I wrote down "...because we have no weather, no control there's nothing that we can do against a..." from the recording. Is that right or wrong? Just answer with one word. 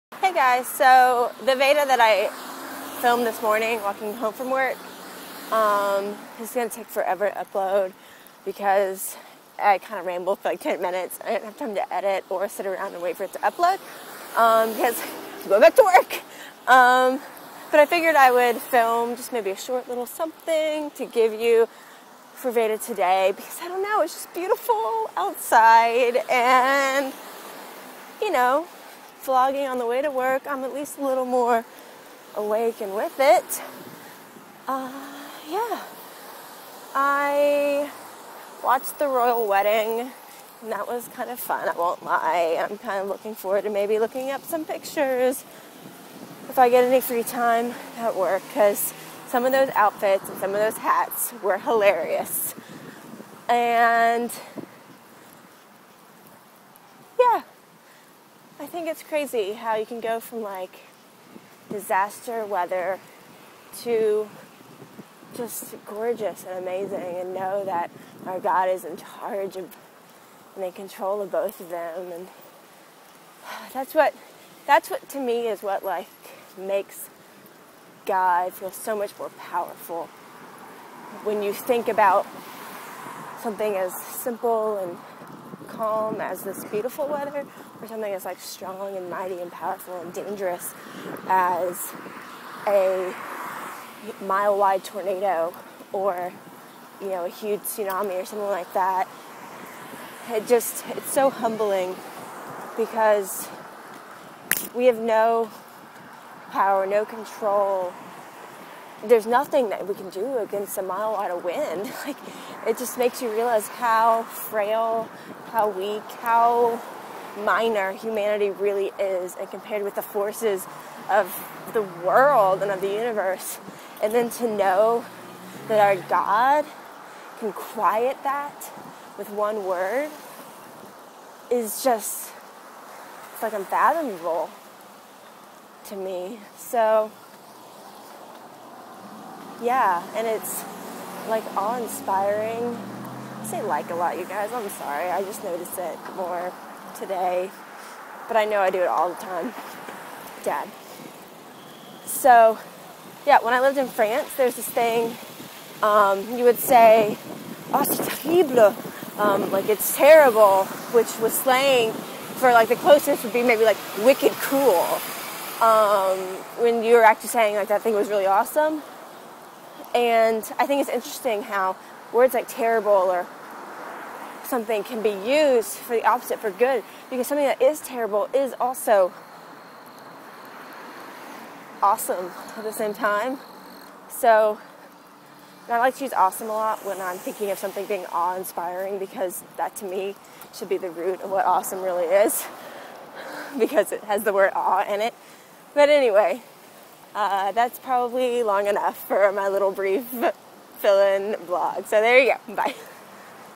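wrong.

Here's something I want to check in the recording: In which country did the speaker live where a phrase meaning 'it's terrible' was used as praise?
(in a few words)
France.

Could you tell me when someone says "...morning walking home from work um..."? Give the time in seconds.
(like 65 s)
3 s.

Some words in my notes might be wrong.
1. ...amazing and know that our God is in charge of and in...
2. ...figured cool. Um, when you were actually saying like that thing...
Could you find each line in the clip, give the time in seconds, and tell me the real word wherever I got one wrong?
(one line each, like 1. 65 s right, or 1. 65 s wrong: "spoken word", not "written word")
1. 66 s right
2. 164 s wrong: "wicked", not "figured".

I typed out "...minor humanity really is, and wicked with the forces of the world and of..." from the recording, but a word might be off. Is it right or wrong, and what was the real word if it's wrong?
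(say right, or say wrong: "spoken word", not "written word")
wrong: "compared", not "wicked".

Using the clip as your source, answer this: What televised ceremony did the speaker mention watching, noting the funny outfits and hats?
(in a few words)
the royal wedding.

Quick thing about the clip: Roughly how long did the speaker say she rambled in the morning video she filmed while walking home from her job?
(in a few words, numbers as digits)
10 minutes.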